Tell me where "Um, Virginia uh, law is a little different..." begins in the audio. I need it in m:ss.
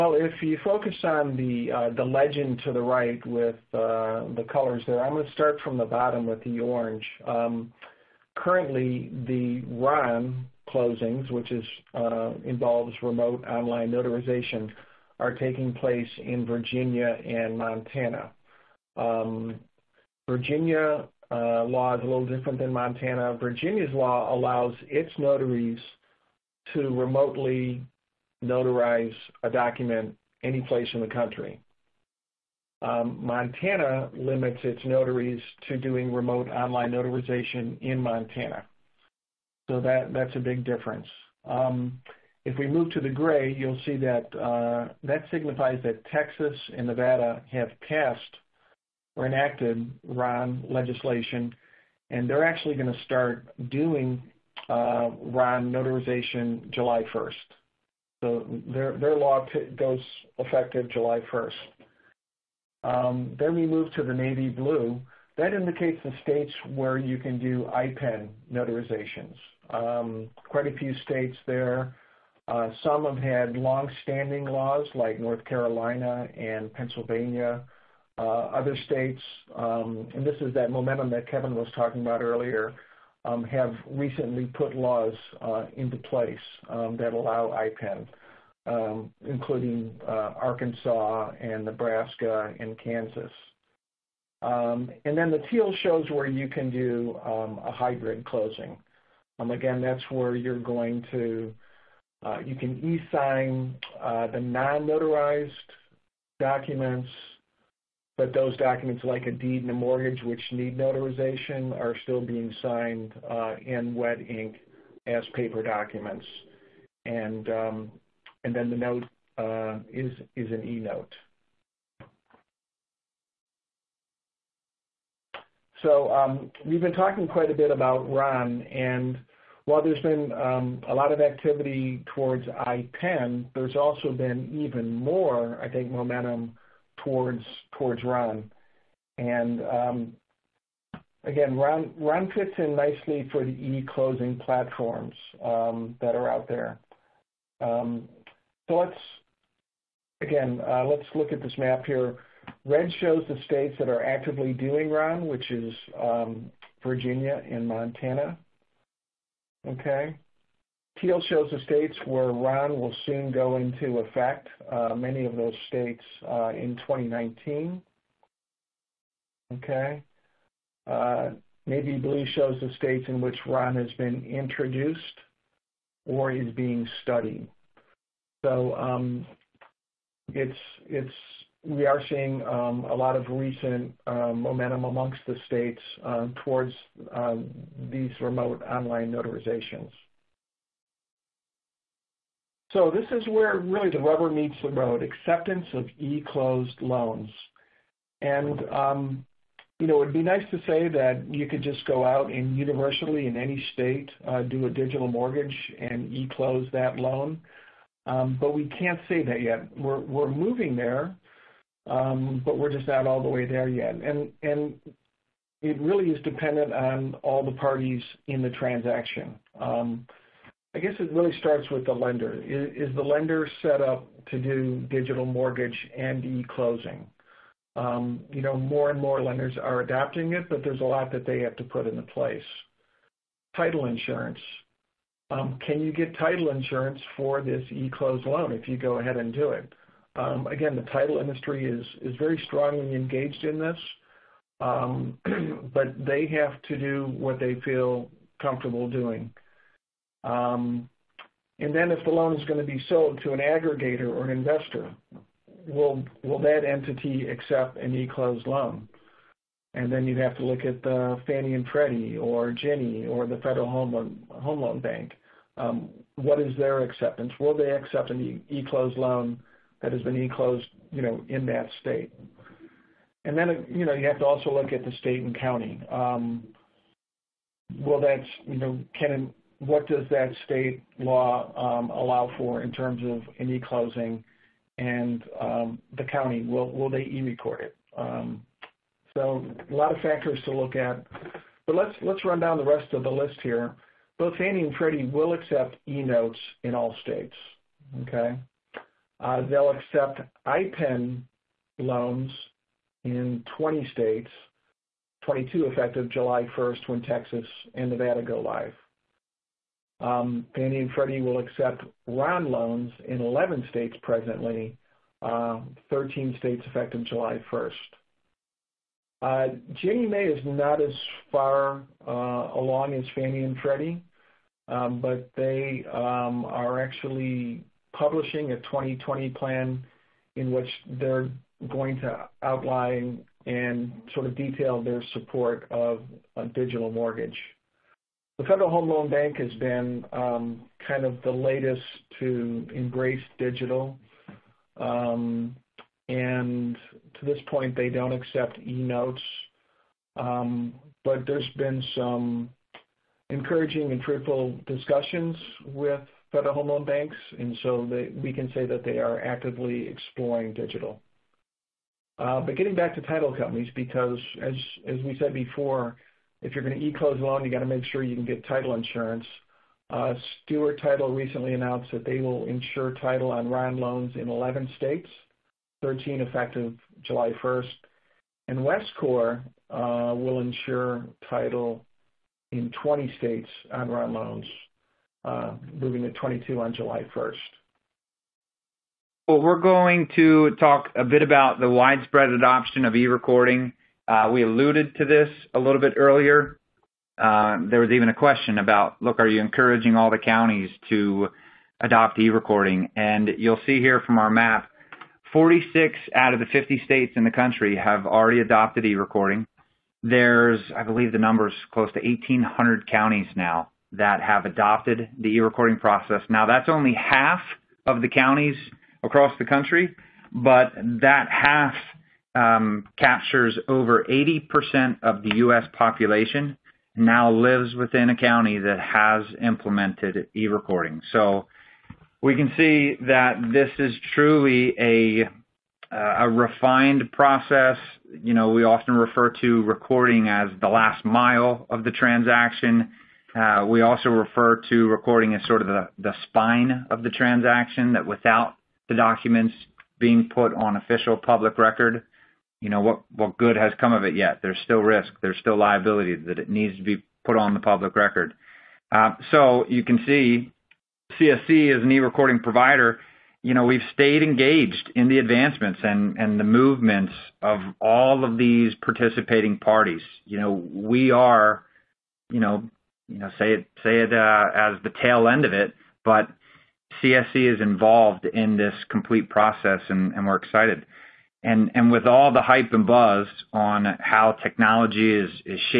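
0:18.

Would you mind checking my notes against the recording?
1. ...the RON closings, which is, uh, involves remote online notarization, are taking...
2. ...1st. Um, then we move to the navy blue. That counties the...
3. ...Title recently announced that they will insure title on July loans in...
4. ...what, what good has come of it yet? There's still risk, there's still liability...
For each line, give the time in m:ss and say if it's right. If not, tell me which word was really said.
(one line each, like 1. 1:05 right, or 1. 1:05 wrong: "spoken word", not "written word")
1. 0:09 right
2. 1:01 wrong: "indicates", not "counties"
3. 6:10 wrong: "RON", not "July"
4. 7:32 right.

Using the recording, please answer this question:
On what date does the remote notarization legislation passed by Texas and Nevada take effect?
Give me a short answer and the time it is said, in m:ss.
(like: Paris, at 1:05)
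July 1st, at 0:52.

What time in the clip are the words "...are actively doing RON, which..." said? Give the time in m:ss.
2:33.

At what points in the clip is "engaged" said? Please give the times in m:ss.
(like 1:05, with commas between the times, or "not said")
4:02, 7:44.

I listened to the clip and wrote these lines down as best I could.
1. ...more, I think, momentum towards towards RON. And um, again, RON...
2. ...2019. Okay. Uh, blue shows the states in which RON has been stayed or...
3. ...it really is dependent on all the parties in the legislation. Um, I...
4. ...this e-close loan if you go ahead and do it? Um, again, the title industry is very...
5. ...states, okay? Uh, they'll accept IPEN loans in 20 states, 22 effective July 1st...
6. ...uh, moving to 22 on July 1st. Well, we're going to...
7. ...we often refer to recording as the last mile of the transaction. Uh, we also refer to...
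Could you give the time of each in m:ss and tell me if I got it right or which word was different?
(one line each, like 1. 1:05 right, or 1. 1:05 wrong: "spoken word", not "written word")
1. 2:14 right
2. 2:46 wrong: "introduced", not "stayed"
3. 3:35 wrong: "transaction", not "legislation"
4. 3:57 right
5. 4:57 right
6. 6:25 right
7. 7:18 right.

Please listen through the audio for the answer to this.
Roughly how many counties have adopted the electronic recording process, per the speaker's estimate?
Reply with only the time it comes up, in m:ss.
6:51.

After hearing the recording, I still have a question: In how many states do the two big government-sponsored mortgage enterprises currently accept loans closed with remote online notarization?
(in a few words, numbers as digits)
11.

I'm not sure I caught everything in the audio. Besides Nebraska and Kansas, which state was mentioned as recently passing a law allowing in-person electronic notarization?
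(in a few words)
Arkansas.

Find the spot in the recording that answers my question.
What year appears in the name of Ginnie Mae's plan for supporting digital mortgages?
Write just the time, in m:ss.
5:28.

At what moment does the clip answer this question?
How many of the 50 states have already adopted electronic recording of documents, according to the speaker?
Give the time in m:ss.
6:45.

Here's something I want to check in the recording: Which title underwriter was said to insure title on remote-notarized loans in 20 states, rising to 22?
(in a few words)
Westcor.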